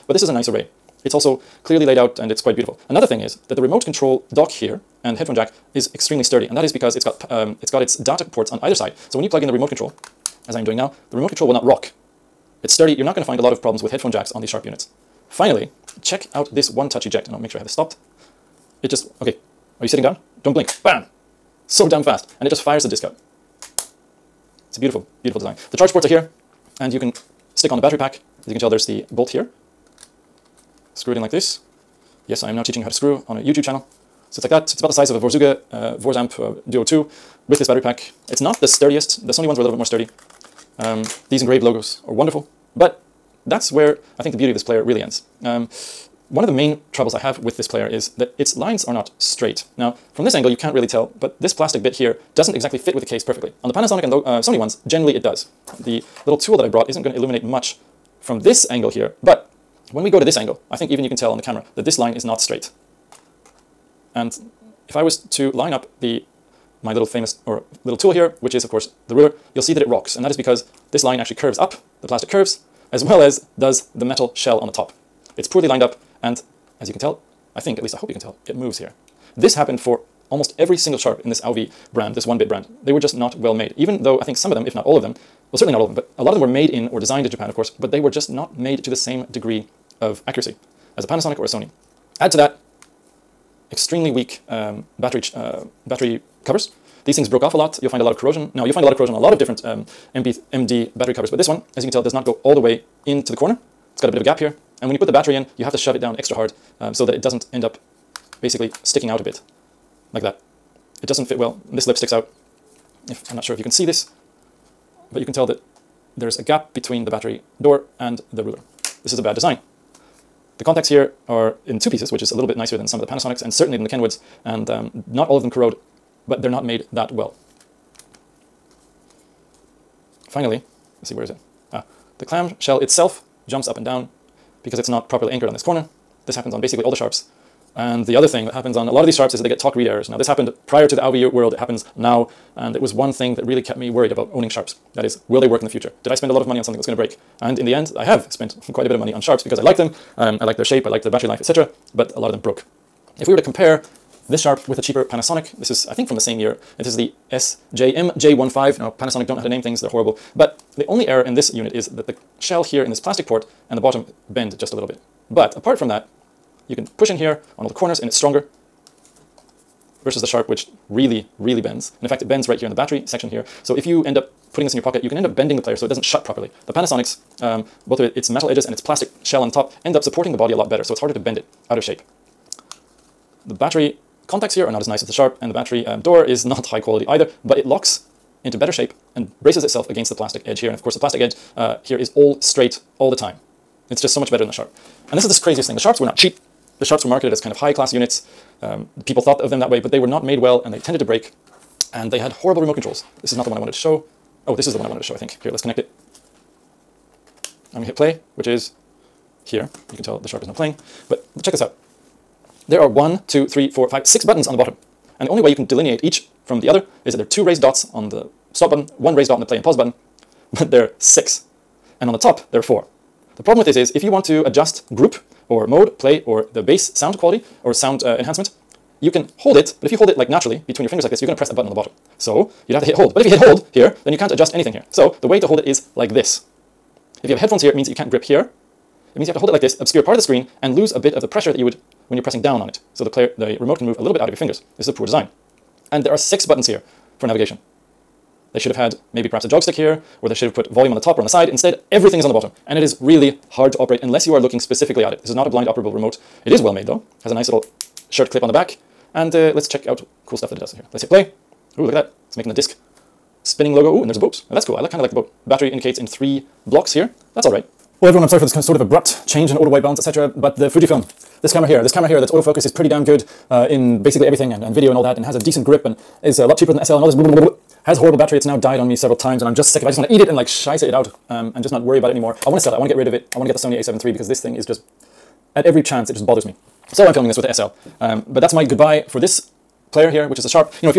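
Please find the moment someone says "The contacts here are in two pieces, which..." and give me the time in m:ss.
2:00.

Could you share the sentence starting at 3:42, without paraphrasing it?
And on the top, there are four.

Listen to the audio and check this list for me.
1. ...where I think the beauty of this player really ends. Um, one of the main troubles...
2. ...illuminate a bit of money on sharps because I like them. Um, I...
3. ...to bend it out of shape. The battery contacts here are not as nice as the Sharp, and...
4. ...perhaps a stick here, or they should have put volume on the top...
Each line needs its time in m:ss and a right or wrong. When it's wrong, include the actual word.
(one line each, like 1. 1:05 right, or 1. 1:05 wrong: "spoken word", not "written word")
1. 0:43 right
2. 2:28 wrong: "quite", not "illuminate"
3. 3:01 right
4. 4:09 right.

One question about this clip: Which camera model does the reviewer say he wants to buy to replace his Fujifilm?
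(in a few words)
Sony a7 III.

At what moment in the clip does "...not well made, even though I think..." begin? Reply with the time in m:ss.
1:23.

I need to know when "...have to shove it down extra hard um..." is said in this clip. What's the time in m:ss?
1:45.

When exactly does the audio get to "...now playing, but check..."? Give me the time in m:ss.
3:30.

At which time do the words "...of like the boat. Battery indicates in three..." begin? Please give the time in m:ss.
4:24.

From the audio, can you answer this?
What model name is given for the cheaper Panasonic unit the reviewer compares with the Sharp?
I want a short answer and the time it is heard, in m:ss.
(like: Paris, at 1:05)
SJMJ15, at 2:37.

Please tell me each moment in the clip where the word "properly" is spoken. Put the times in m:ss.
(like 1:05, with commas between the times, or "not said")
2:15, 2:56.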